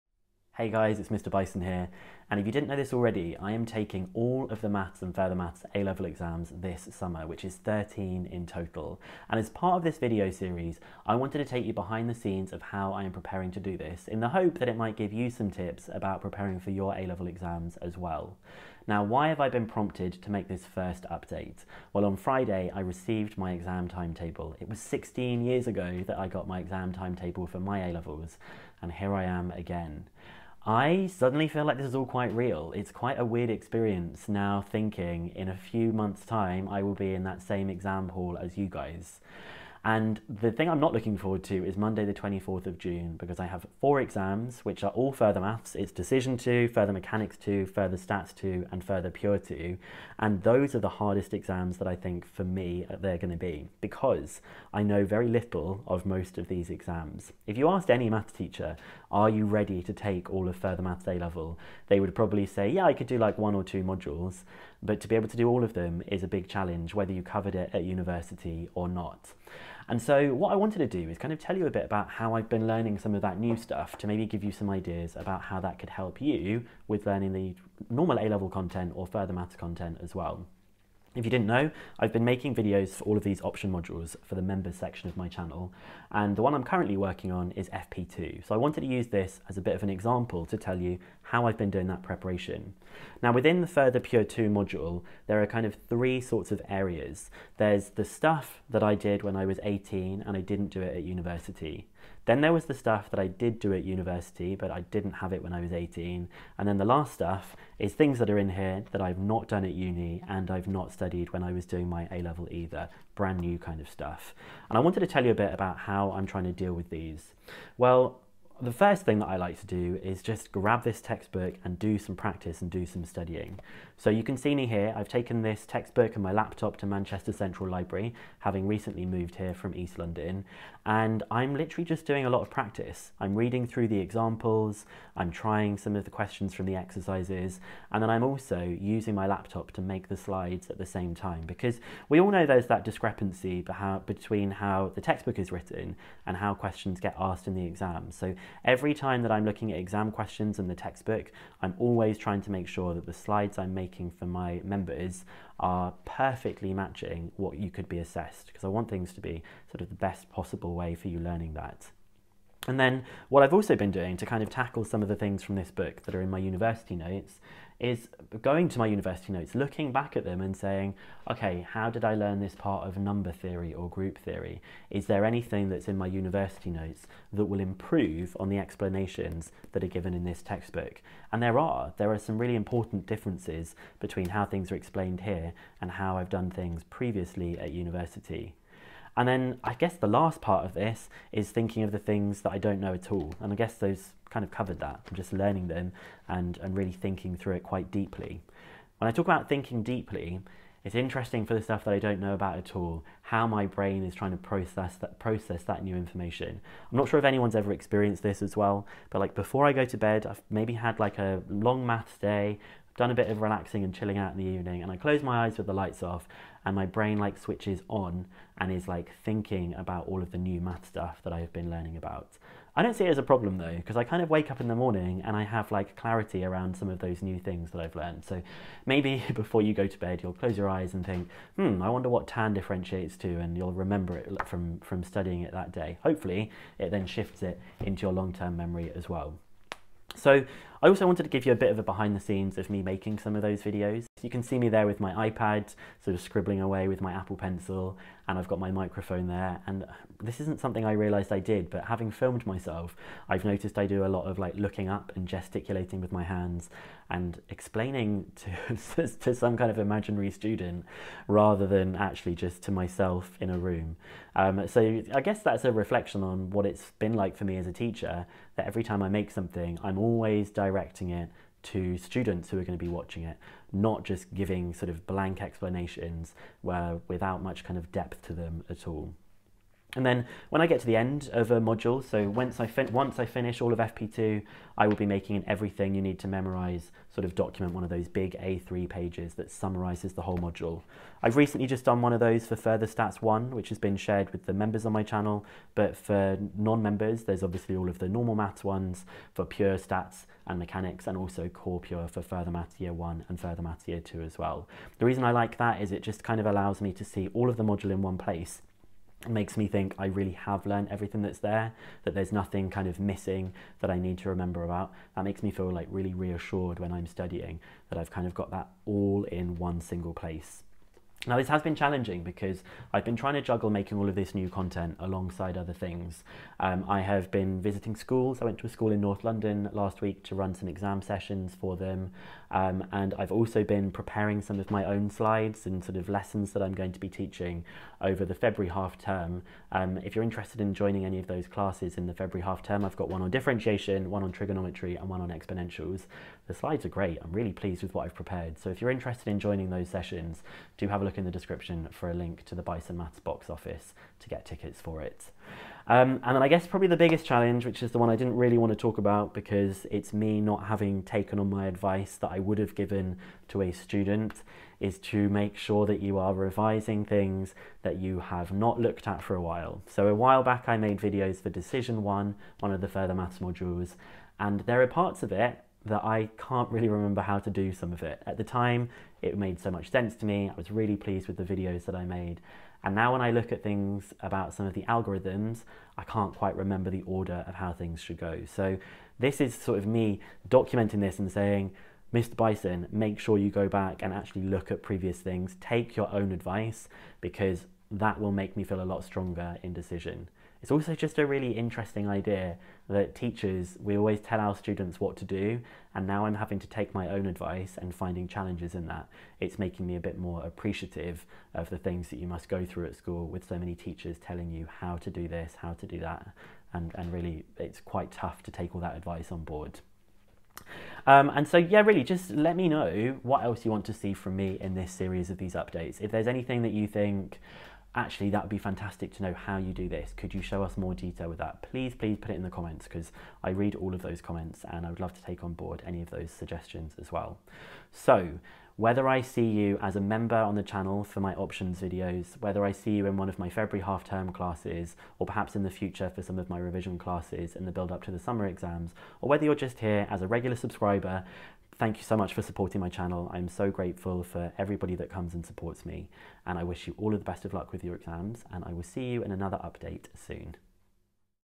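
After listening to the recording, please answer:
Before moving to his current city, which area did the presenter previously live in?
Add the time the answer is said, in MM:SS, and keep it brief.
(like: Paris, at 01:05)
East London, at 02:09.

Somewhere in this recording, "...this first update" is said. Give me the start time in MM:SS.
00:20.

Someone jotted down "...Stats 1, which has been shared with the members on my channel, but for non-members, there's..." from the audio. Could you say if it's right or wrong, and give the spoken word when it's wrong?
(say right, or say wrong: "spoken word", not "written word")
right.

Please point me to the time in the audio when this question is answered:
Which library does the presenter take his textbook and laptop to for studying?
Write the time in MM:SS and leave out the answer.
02:06.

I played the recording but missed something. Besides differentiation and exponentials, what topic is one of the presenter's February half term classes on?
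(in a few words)
Trigonometry.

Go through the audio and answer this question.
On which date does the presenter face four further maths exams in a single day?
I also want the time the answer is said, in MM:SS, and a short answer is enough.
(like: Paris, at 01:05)
Monday, 24th of June, at 00:41.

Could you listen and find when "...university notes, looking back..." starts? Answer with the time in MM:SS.
02:48.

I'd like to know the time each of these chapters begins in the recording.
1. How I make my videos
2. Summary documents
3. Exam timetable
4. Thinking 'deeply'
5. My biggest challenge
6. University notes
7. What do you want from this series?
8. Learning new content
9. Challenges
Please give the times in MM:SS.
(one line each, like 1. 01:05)
1. 04:00
2. 04:40
3. 00:21
4. 03:18
5. 05:55
6. 02:43
7. 07:00
8. 01:10
9. 05:21.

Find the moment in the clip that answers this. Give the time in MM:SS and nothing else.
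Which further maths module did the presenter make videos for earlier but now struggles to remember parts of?
06:11.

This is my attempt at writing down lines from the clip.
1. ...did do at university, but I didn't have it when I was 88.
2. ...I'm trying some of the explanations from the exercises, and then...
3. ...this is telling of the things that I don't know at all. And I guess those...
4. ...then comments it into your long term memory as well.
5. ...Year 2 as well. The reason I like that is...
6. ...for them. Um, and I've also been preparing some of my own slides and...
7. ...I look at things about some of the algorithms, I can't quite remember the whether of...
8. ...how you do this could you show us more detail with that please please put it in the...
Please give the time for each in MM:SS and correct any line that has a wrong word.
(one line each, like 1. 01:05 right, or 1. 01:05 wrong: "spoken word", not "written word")
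1. 01:43 wrong: "18", not "88"
2. 02:15 wrong: "questions", not "explanations"
3. 03:10 wrong: "thinking", not "telling"
4. 03:56 wrong: "shifts", not "comments"
5. 05:03 right
6. 05:31 right
7. 06:23 wrong: "order", not "whether"
8. 07:09 right.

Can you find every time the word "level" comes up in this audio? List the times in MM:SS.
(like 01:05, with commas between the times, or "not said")
00:05, 00:17, 00:27, 01:01, 01:18, 01:52.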